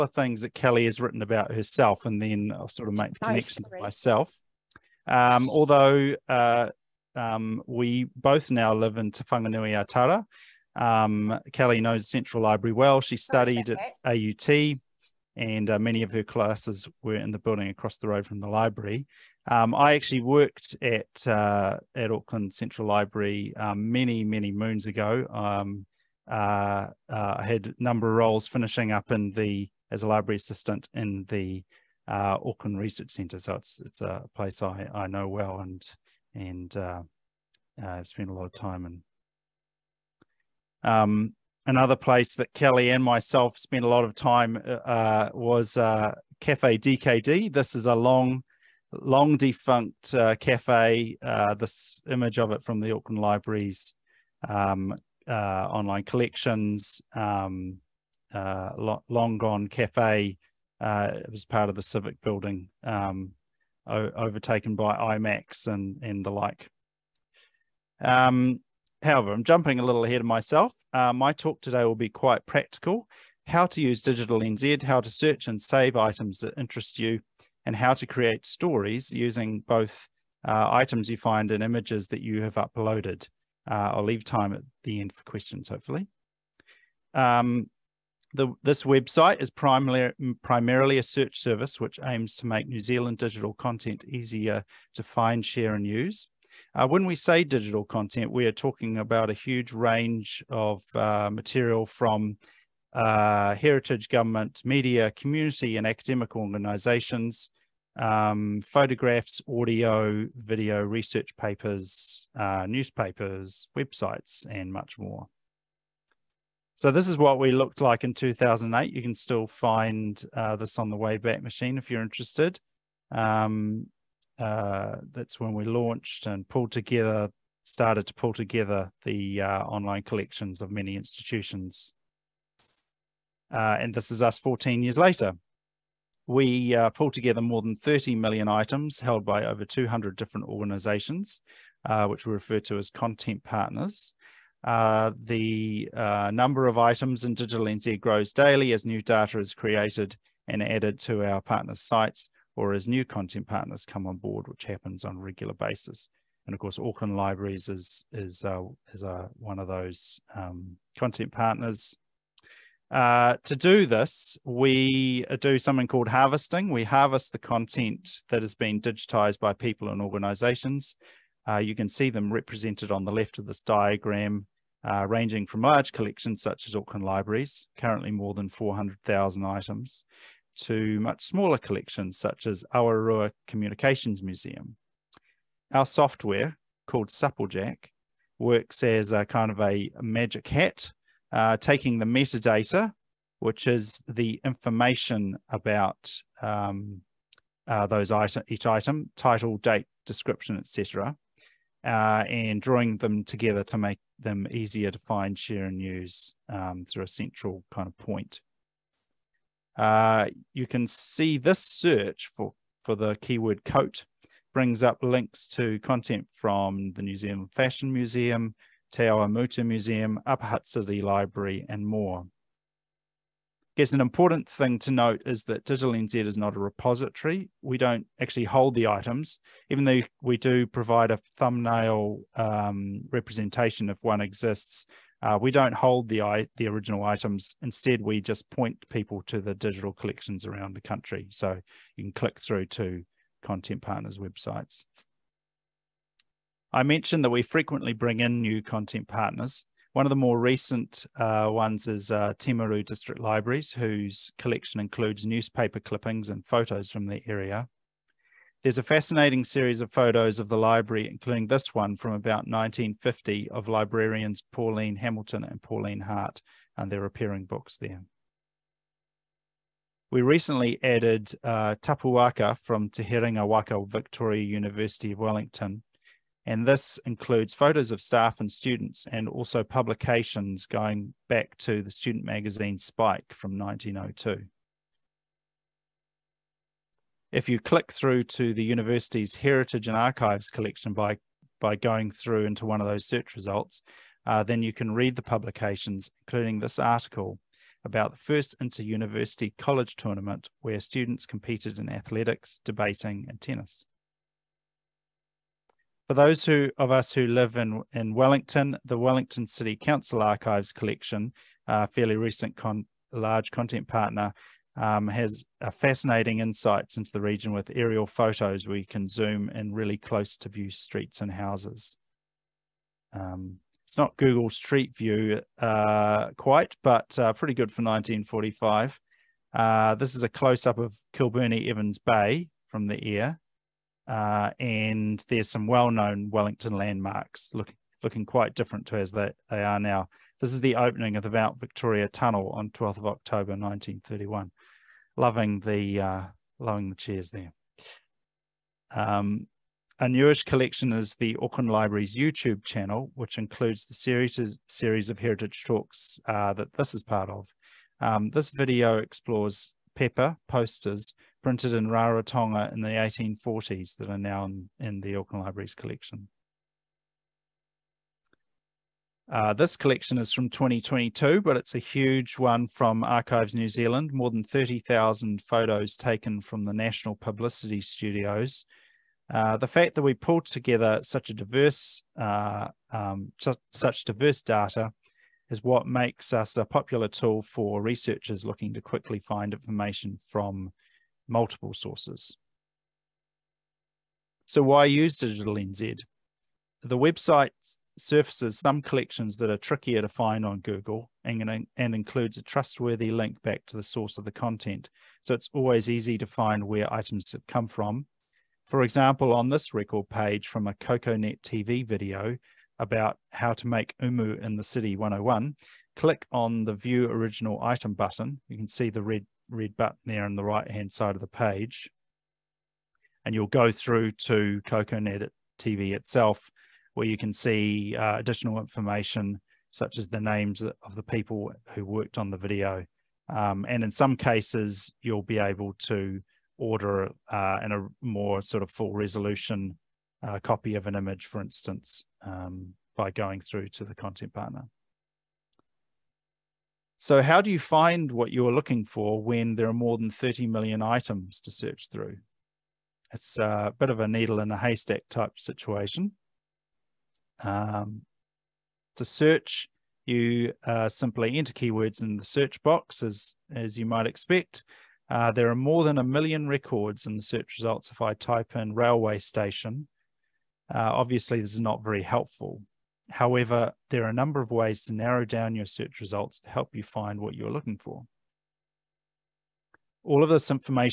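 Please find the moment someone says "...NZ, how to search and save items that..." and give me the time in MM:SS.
01:14.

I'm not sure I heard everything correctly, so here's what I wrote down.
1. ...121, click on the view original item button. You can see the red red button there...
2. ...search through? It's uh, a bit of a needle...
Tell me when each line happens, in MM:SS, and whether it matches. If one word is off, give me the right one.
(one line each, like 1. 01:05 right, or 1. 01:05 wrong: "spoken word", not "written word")
1. 06:54 wrong: "101", not "121"
2. 07:31 right.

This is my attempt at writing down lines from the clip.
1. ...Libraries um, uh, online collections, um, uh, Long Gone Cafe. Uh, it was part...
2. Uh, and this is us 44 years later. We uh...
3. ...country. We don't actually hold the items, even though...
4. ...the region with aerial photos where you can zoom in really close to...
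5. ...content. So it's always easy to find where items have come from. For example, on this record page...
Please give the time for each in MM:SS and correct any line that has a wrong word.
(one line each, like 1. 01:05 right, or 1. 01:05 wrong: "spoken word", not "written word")
1. 00:53 right
2. 02:13 wrong: "14", not "44"
3. 03:46 wrong: "repository", not "country"
4. 05:17 right
5. 06:44 right.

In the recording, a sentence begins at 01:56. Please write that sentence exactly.
So this is what we looked like in 2008.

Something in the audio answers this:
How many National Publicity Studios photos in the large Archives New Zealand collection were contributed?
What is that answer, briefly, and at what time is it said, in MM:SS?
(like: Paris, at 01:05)
more than 30,000, at 06:14.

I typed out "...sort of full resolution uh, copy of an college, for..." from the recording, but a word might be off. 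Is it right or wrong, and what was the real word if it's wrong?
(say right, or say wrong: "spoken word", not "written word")
wrong: "image", not "college".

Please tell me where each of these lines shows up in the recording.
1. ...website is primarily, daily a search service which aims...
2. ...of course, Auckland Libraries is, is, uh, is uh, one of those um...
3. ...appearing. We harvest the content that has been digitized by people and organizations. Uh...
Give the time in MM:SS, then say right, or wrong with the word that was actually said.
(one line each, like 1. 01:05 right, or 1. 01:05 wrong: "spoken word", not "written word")
1. 01:28 wrong: "primarily", not "daily"
2. 02:36 right
3. 02:46 wrong: "harvesting", not "appearing".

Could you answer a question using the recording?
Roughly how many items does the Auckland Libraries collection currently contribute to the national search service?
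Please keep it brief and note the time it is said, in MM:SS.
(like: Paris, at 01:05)
more than 400,000, at 02:58.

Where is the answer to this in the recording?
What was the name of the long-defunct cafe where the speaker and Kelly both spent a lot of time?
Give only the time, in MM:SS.
00:45.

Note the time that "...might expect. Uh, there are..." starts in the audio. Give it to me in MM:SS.
07:43.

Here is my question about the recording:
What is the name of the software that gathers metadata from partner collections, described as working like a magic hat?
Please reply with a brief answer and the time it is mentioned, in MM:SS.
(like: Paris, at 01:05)
Supplejack, at 03:07.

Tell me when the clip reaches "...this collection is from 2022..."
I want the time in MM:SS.
06:09.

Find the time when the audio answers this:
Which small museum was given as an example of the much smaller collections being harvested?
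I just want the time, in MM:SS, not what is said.
03:02.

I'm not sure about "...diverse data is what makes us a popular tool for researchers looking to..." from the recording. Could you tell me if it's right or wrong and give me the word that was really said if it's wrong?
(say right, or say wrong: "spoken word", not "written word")
right.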